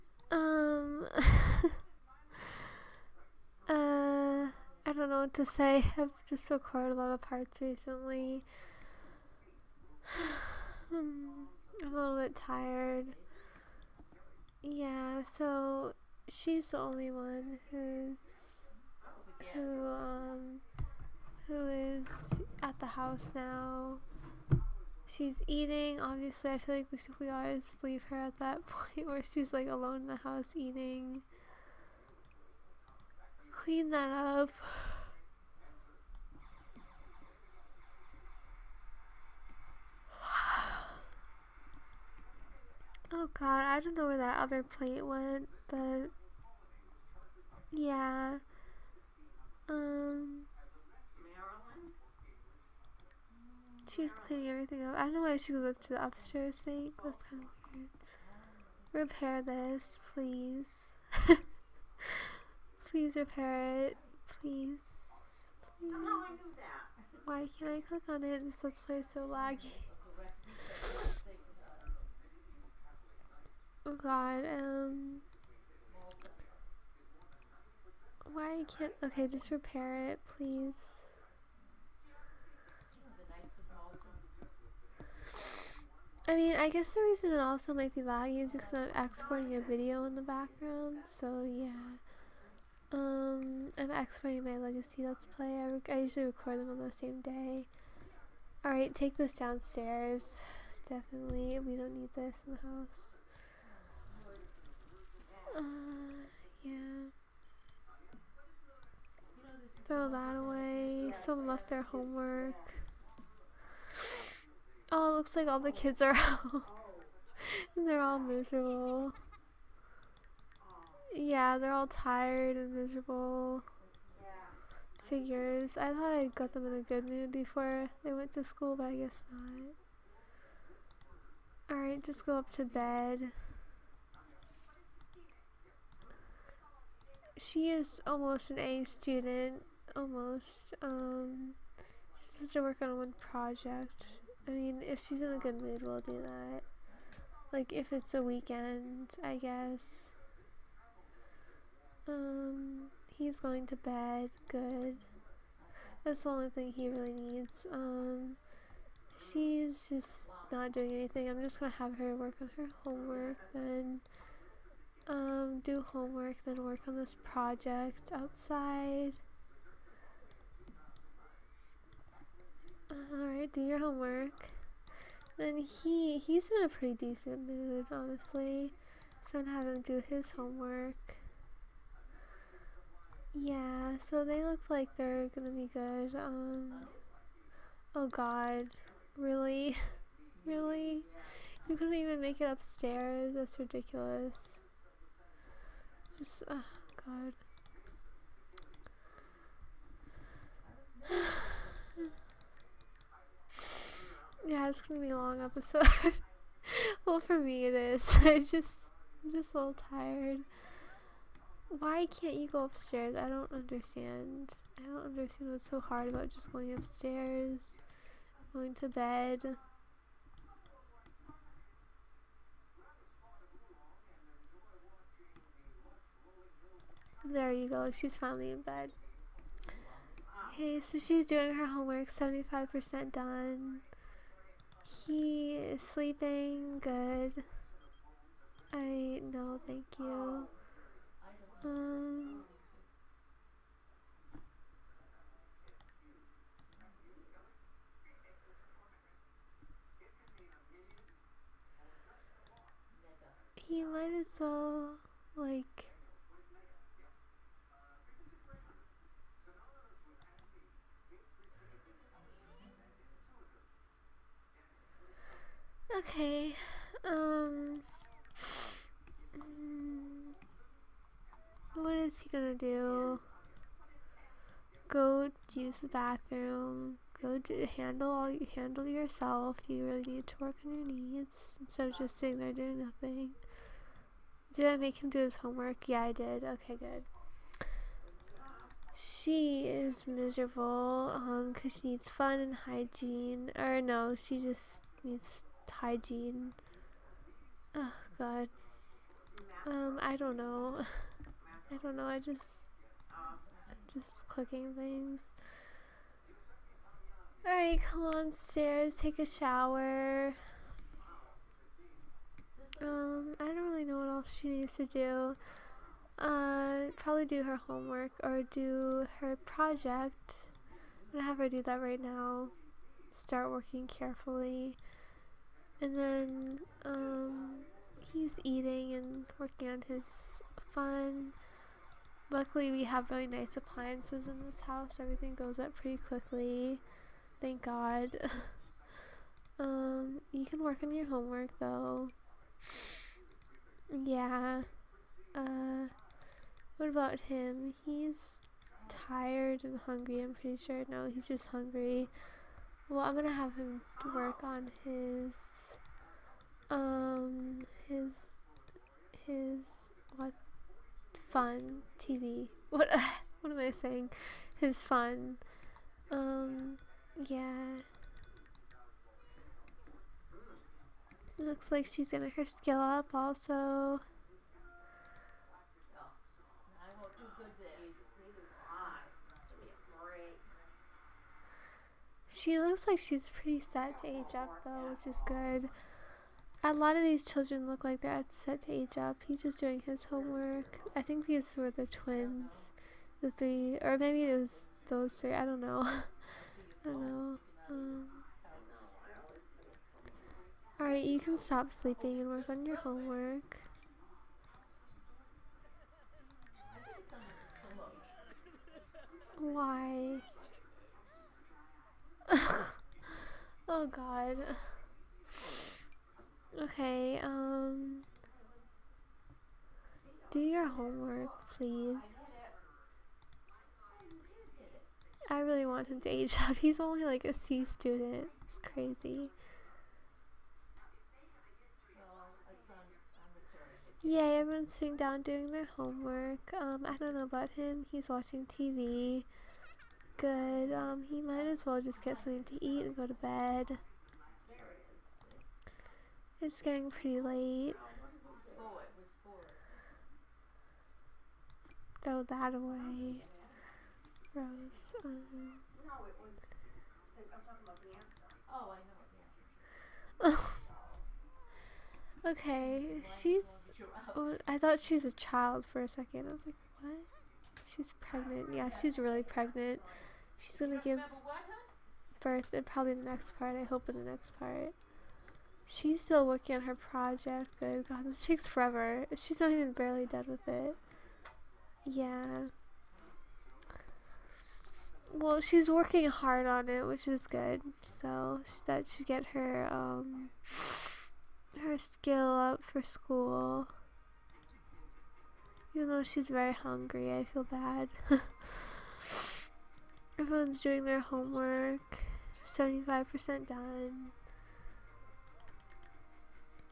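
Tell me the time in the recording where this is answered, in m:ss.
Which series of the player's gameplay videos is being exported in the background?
1:34.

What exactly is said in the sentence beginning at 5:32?
Luckily, we have really nice appliances in this house.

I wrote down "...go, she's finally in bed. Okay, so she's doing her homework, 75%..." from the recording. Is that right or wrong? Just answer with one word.
right.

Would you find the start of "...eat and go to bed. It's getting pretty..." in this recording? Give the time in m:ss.
7:22.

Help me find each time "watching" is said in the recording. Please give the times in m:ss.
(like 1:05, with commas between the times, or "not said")
7:18.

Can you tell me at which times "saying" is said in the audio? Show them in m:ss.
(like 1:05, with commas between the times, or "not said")
6:03.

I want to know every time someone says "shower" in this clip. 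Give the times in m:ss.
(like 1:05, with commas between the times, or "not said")
5:09.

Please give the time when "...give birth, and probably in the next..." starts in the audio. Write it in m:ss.
7:50.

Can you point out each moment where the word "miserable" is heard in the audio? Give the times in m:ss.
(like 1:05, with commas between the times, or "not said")
1:58, 2:02, 4:50.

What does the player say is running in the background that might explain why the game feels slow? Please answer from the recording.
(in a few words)
Exporting a video.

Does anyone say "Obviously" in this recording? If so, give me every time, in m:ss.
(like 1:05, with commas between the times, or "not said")
0:25.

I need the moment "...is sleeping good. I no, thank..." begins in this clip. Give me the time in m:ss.
3:55.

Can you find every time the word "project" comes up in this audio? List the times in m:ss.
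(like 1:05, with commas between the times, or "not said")
2:23, 2:47, 5:19, 7:56.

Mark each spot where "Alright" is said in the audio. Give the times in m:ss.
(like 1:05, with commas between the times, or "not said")
1:38, 2:11, 2:53, 5:07, 6:40.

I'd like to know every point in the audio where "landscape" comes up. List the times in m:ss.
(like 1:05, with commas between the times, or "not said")
not said.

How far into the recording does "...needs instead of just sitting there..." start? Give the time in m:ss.
4:40.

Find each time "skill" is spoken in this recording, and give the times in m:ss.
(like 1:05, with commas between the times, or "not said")
6:12, 8:11.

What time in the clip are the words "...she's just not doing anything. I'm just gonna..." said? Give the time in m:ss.
2:39.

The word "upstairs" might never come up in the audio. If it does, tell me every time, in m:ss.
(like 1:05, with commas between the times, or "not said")
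0:56, 3:12, 3:32, 3:36.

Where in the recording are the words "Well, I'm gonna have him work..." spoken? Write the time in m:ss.
5:52.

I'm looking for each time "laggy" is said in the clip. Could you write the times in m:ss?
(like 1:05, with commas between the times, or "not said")
1:09, 1:27.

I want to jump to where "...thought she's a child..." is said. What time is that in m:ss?
7:44.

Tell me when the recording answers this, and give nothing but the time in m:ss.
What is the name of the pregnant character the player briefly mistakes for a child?
7:34.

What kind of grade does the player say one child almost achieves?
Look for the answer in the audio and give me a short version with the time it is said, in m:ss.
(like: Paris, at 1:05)
An A student, at 2:18.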